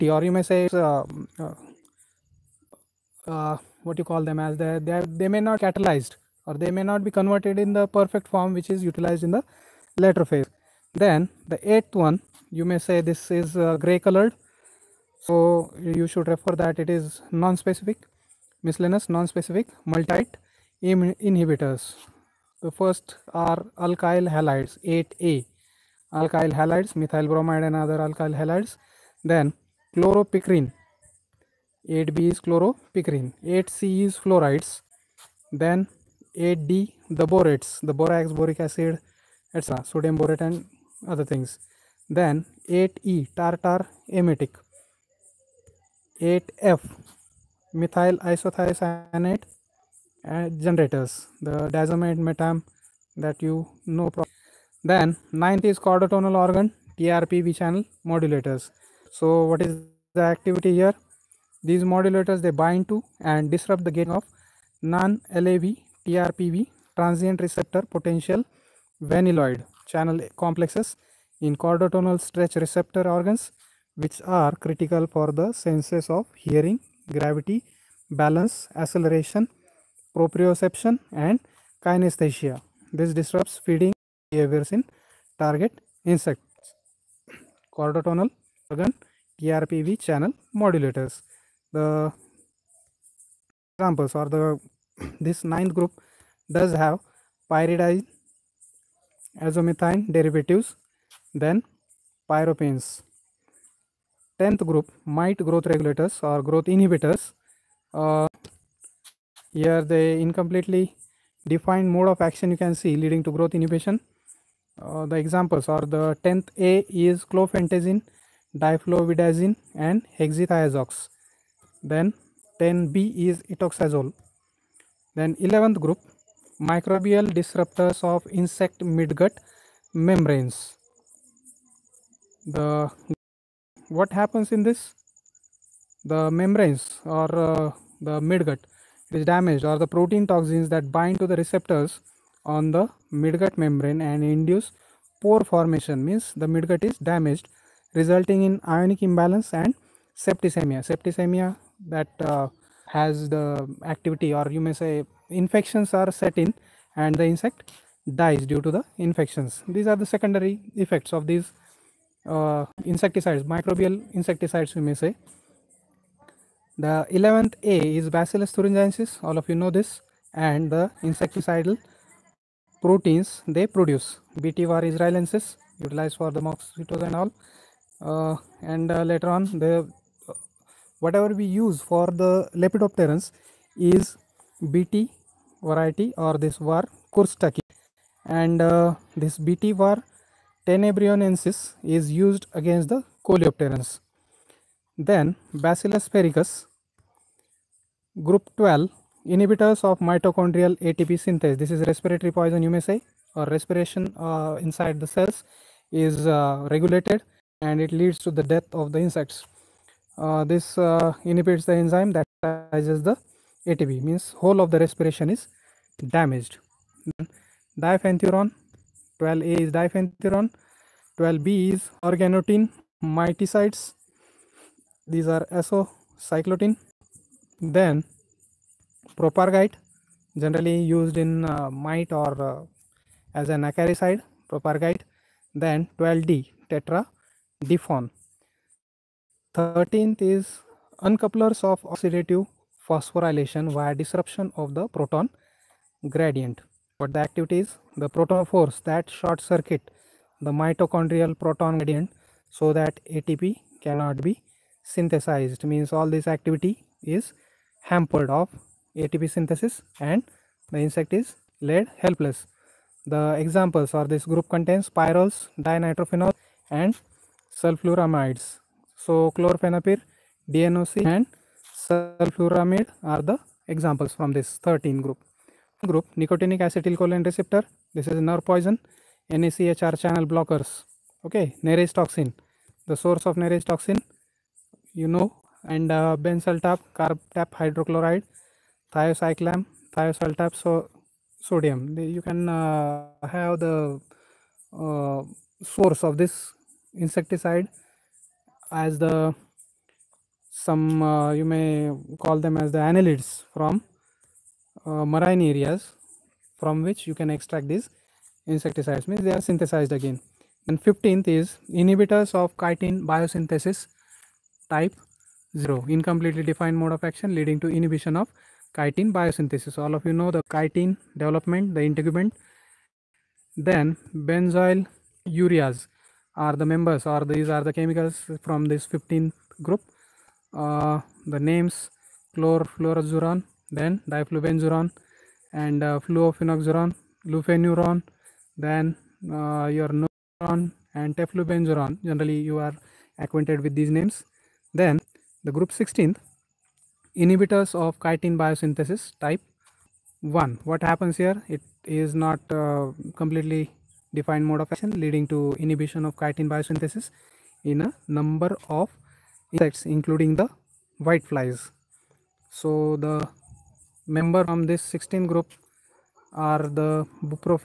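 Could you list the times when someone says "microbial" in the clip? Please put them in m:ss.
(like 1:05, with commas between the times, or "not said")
2:06, 2:43.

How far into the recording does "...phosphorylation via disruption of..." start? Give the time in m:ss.
4:02.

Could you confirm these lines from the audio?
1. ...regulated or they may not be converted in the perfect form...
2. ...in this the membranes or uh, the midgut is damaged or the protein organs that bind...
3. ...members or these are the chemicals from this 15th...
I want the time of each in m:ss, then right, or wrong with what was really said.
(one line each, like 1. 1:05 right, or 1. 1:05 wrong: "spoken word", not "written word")
1. 0:05 wrong: "catalyzed", not "regulated"
2. 2:14 wrong: "toxins", not "organs"
3. 5:26 right.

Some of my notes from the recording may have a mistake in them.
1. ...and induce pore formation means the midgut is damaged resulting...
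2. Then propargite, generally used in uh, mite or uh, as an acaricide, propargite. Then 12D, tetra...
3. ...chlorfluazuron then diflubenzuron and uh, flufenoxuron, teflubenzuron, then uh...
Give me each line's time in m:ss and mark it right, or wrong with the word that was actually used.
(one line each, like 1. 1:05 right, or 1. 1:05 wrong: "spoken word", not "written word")
1. 2:24 right
2. 3:47 right
3. 5:32 wrong: "lufenuron", not "teflubenzuron".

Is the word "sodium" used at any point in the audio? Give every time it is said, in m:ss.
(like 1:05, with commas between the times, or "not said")
0:39, 4:51.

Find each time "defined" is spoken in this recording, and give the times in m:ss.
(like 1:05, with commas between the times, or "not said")
1:51, 5:16, 5:54.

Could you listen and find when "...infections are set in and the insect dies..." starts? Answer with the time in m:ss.
2:35.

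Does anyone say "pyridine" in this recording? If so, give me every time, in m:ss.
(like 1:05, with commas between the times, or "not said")
1:37.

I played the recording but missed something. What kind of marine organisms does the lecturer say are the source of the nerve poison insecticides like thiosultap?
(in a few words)
Annelids.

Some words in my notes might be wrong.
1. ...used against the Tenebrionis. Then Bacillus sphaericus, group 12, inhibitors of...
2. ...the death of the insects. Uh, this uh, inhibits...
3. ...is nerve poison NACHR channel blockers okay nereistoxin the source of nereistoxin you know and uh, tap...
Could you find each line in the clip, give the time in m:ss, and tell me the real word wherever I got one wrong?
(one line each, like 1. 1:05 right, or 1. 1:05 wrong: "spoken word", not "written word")
1. 3:12 wrong: "Coleopterans", not "Tenebrionis"
2. 3:28 right
3. 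4:38 right.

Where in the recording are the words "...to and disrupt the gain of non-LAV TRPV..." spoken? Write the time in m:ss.
1:02.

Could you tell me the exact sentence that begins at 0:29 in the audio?
Then chloropicrin, 8B is chloropicrin, 8C is fluorides.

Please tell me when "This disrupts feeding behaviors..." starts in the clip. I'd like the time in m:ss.
1:22.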